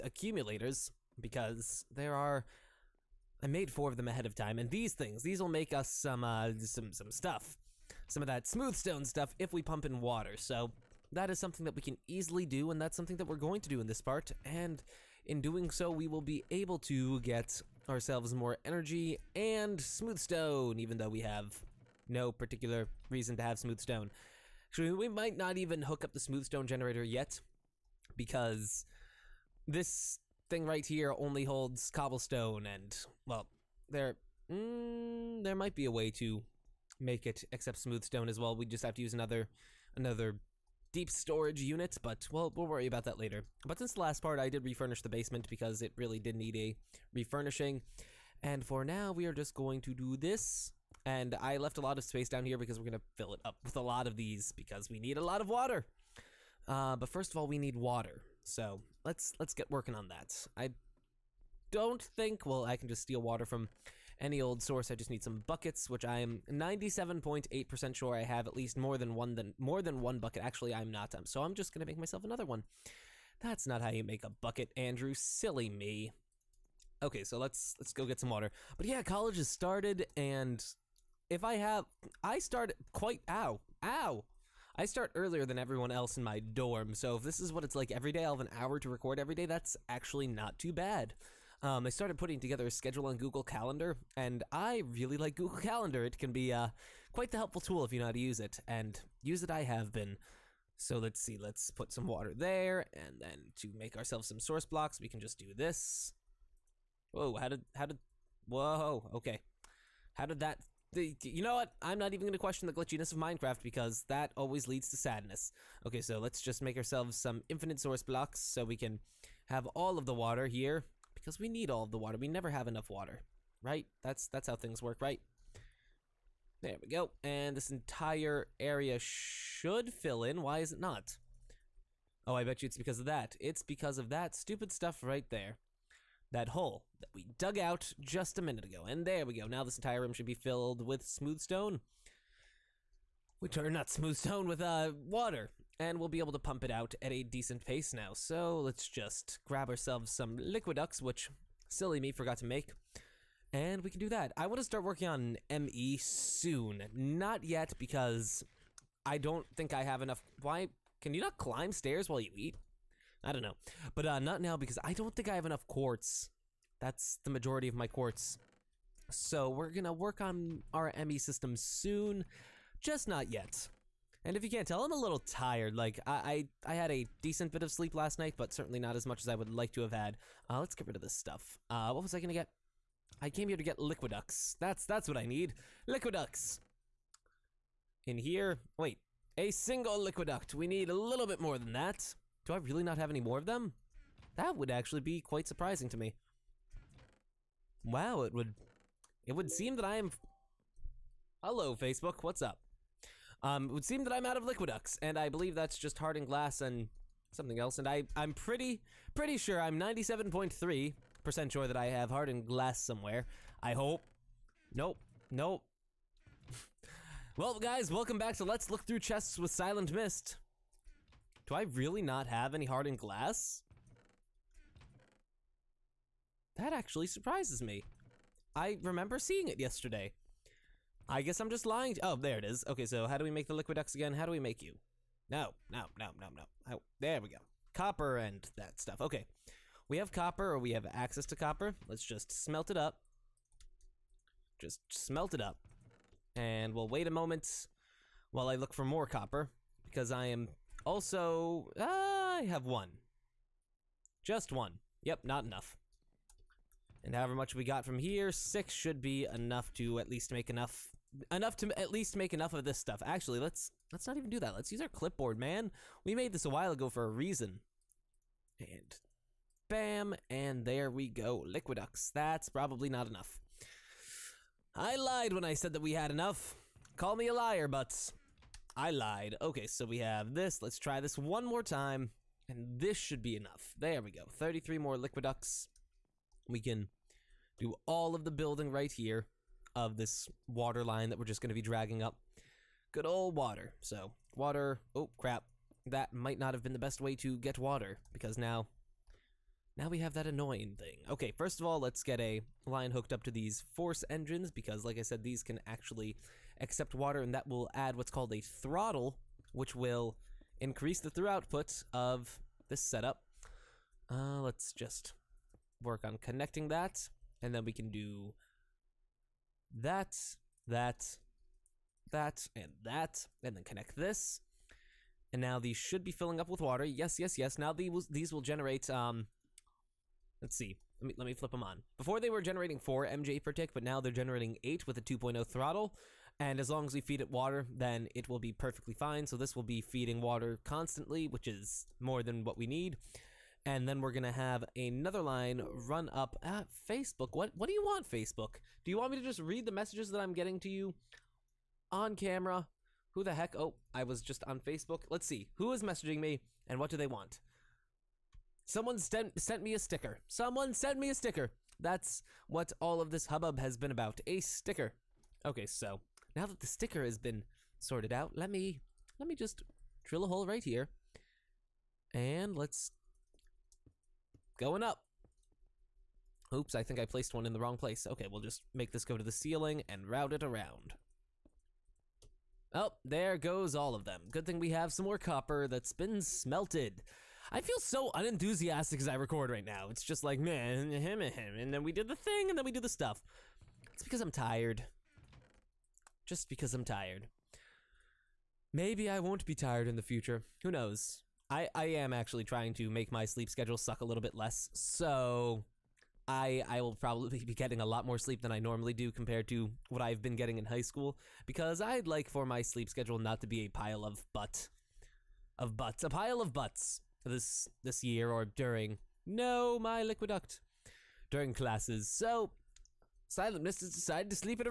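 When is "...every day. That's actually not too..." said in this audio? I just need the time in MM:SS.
01:29.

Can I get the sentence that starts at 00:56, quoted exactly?
Uh, but first of all, we need water.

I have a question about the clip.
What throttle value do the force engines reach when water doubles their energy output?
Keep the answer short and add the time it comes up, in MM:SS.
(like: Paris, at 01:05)
2.0, at 05:35.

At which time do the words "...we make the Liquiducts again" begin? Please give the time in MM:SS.
03:53.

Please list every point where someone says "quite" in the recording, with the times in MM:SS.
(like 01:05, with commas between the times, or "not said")
01:22, 01:37, 03:15.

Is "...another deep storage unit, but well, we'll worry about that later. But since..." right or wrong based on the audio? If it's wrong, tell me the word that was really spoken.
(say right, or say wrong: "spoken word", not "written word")
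right.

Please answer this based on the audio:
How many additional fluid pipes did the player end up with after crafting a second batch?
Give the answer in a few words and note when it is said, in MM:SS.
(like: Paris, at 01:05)
33, at 04:44.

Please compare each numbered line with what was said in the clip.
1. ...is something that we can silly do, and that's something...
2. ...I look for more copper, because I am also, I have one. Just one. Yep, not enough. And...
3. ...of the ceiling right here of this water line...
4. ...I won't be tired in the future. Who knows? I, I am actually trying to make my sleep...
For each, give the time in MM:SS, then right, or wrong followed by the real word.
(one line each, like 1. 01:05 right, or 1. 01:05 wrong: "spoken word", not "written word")
1. 00:11 wrong: "easily", not "silly"
2. 04:08 right
3. 04:48 wrong: "building", not "ceiling"
4. 06:39 right.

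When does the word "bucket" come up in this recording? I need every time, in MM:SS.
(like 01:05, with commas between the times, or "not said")
01:05, 01:10, 01:14.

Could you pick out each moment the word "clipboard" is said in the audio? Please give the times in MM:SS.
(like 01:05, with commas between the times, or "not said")
04:24.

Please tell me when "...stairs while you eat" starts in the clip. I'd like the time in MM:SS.
02:41.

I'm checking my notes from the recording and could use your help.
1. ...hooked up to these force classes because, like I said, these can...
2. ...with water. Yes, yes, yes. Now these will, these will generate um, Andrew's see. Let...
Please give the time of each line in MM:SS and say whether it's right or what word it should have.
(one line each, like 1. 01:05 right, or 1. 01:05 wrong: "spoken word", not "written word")
1. 05:02 wrong: "engines", not "classes"
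2. 05:26 wrong: "Let", not "Andrew".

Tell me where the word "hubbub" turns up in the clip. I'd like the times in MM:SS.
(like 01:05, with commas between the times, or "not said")
06:03.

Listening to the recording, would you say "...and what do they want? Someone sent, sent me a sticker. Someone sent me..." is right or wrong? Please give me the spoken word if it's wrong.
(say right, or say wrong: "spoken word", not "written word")
right.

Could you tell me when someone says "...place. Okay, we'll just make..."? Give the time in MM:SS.
06:17.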